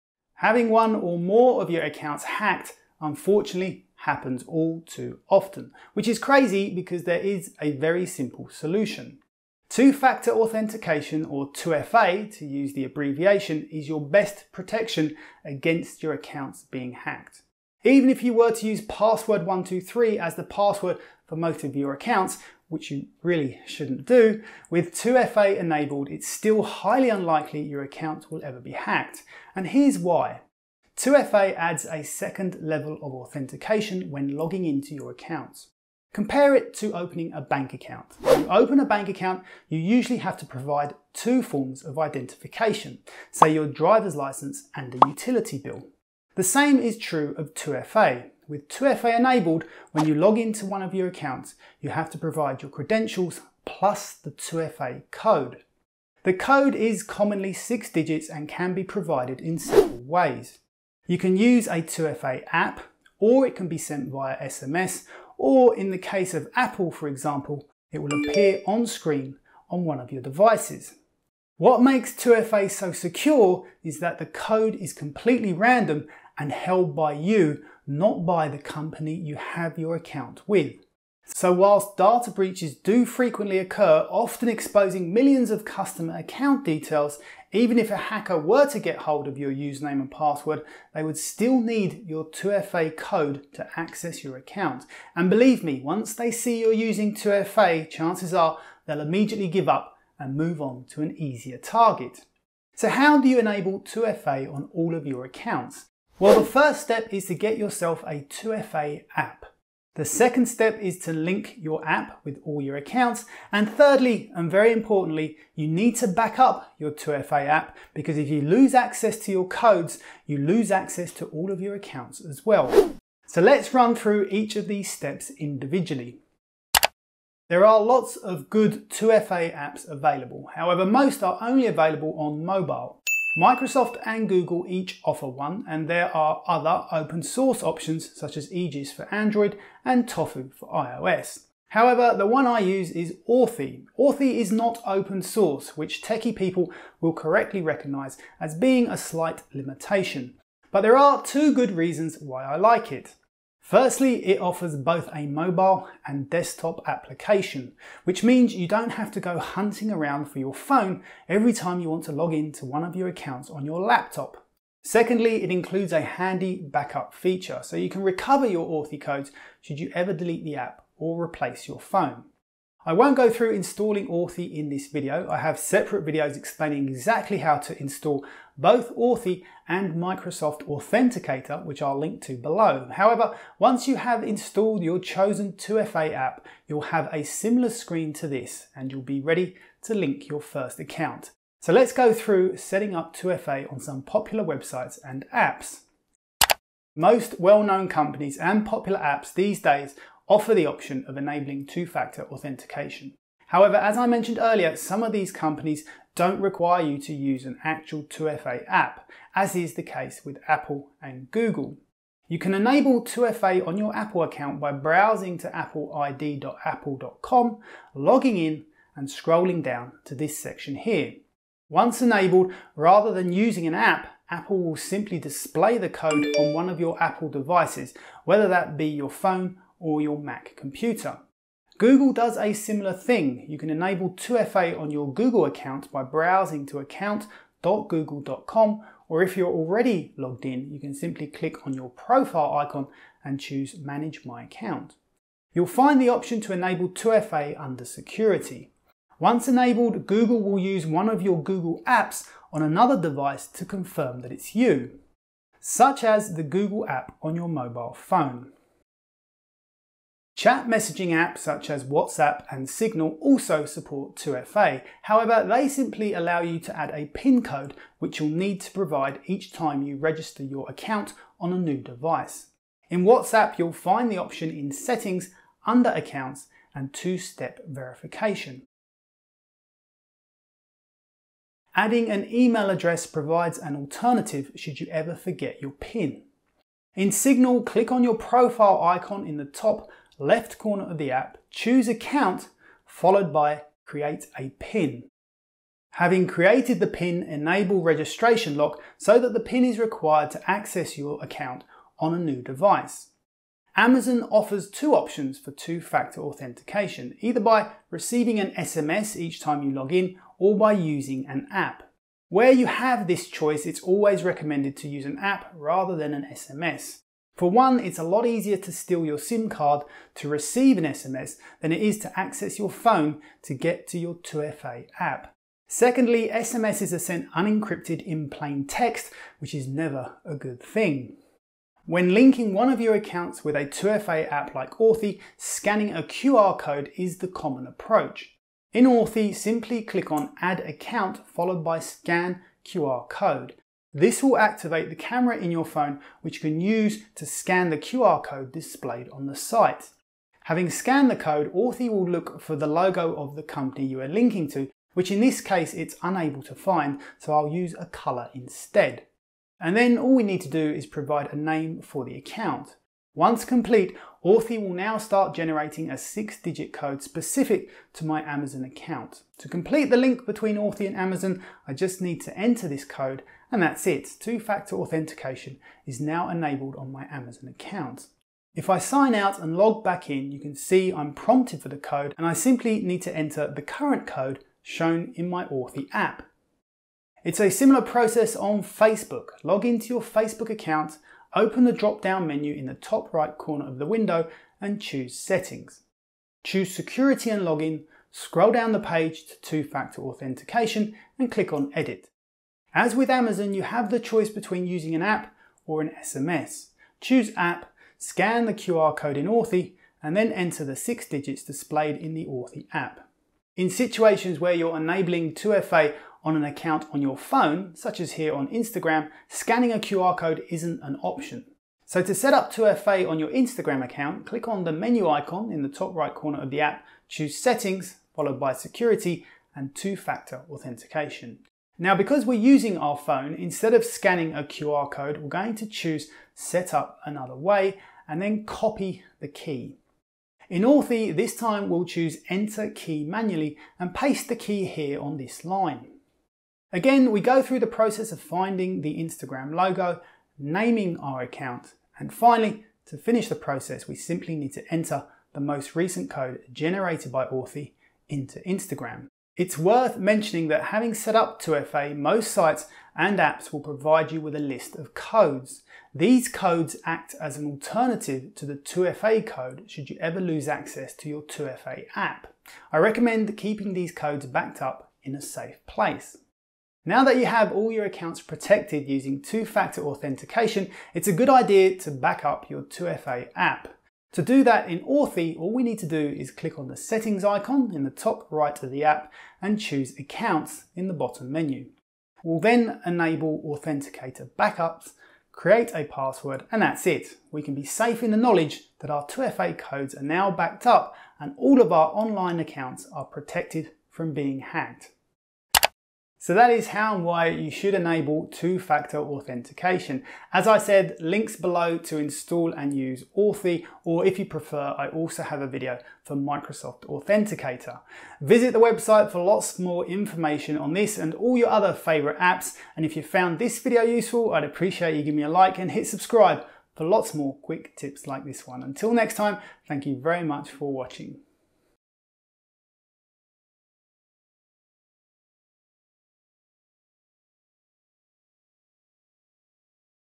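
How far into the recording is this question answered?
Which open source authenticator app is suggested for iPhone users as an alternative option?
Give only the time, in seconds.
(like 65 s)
140 s.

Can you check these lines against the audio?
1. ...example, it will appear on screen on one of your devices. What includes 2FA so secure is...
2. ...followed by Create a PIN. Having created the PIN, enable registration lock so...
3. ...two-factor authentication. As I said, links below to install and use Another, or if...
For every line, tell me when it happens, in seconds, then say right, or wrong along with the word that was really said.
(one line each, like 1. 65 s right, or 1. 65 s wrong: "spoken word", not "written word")
1. 67 s wrong: "makes", not "includes"
2. 292 s right
3. 508 s wrong: "Authy", not "Another".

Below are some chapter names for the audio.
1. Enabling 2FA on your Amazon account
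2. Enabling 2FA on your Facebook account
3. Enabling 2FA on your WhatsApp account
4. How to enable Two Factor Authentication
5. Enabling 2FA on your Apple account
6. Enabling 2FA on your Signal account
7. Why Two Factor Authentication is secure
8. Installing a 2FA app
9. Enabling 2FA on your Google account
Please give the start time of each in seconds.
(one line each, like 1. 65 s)
1. 303 s
2. 386 s
3. 259 s
4. 101 s
5. 196 s
6. 286 s
7. 70 s
8. 126 s
9. 230 s.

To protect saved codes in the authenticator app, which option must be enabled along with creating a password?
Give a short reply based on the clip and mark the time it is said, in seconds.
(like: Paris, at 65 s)
authenticator backups, at 493 s.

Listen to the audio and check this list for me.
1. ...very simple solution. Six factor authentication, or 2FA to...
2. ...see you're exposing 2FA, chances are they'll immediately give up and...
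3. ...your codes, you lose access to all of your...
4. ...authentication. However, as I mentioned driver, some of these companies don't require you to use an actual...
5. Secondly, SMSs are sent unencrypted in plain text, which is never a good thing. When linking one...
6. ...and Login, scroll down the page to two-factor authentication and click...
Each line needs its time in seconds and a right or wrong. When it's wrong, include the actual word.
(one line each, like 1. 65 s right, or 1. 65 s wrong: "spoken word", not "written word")
1. 7 s wrong: "Two", not "Six"
2. 96 s wrong: "using", not "exposing"
3. 119 s right
4. 202 s wrong: "earlier", not "driver"
5. 325 s right
6. 397 s right.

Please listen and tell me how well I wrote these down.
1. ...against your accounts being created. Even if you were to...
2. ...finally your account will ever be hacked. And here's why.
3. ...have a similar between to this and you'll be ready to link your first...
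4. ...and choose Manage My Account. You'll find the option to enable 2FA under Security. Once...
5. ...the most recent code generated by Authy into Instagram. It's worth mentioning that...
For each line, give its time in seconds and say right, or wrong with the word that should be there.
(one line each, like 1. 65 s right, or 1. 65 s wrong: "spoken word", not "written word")
1. 15 s wrong: "hacked", not "created"
2. 27 s wrong: "unlikely", not "finally"
3. 186 s wrong: "screen", not "between"
4. 243 s right
5. 455 s right.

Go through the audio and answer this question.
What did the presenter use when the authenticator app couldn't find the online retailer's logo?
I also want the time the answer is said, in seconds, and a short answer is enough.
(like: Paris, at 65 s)
a colour, at 357 s.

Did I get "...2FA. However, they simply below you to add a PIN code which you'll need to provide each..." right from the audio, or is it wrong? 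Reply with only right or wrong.
wrong.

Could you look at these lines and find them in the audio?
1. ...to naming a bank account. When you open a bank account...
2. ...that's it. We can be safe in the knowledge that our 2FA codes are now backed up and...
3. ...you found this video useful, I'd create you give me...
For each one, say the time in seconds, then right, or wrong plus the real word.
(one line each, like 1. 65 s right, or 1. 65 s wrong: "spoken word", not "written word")
1. 36 s wrong: "opening", not "naming"
2. 496 s right
3. 522 s wrong: "appreciate", not "create".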